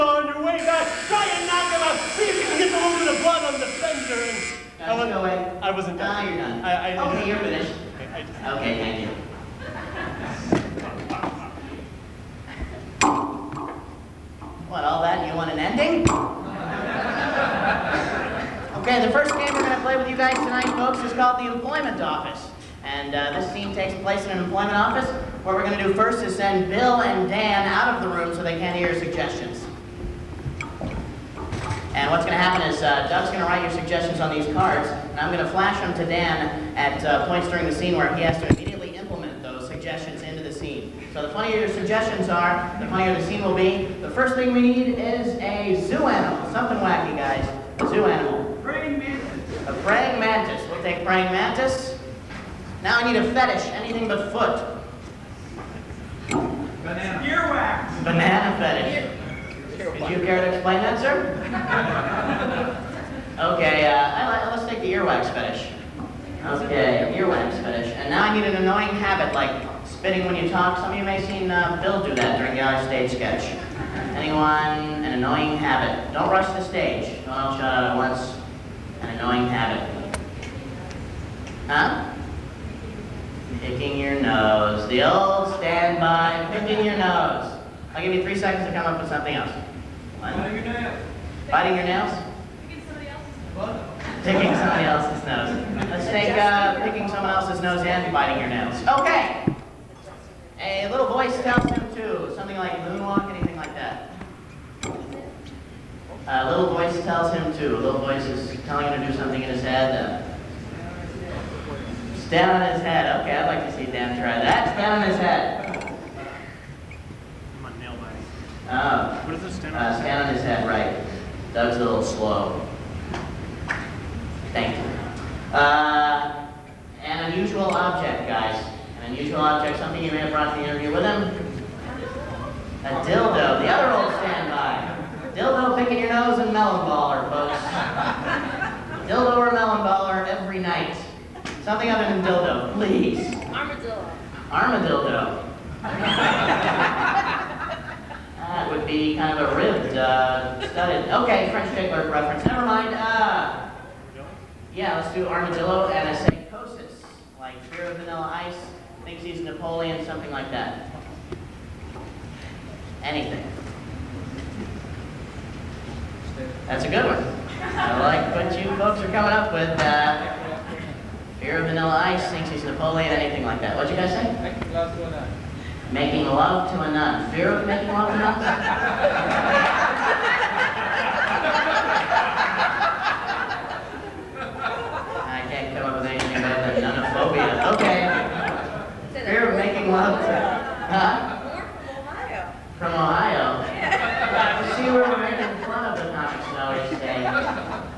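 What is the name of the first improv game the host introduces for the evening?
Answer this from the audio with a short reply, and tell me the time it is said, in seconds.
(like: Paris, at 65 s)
The Employment Office, at 21 s.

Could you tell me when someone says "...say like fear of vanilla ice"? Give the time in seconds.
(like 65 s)
156 s.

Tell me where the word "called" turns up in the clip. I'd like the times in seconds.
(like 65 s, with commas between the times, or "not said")
21 s.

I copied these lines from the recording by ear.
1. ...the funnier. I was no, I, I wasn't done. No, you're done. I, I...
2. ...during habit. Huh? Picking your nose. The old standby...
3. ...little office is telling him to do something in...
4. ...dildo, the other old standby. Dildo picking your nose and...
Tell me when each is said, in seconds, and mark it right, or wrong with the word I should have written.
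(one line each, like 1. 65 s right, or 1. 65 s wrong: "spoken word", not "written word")
1. 3 s wrong: "fender", not "funnier"
2. 79 s wrong: "annoying", not "during"
3. 107 s wrong: "voice", not "office"
4. 133 s right.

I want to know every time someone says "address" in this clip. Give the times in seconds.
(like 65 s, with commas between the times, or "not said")
not said.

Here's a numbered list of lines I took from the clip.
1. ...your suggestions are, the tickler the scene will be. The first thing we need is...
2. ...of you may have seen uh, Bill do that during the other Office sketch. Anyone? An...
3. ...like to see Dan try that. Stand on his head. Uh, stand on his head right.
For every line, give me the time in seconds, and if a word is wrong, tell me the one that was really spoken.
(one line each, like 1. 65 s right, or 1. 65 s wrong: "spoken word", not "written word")
1. 41 s wrong: "funnier", not "tickler"
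2. 70 s wrong: "Stage", not "Office"
3. 113 s right.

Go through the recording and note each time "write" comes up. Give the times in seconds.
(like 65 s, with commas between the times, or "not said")
33 s.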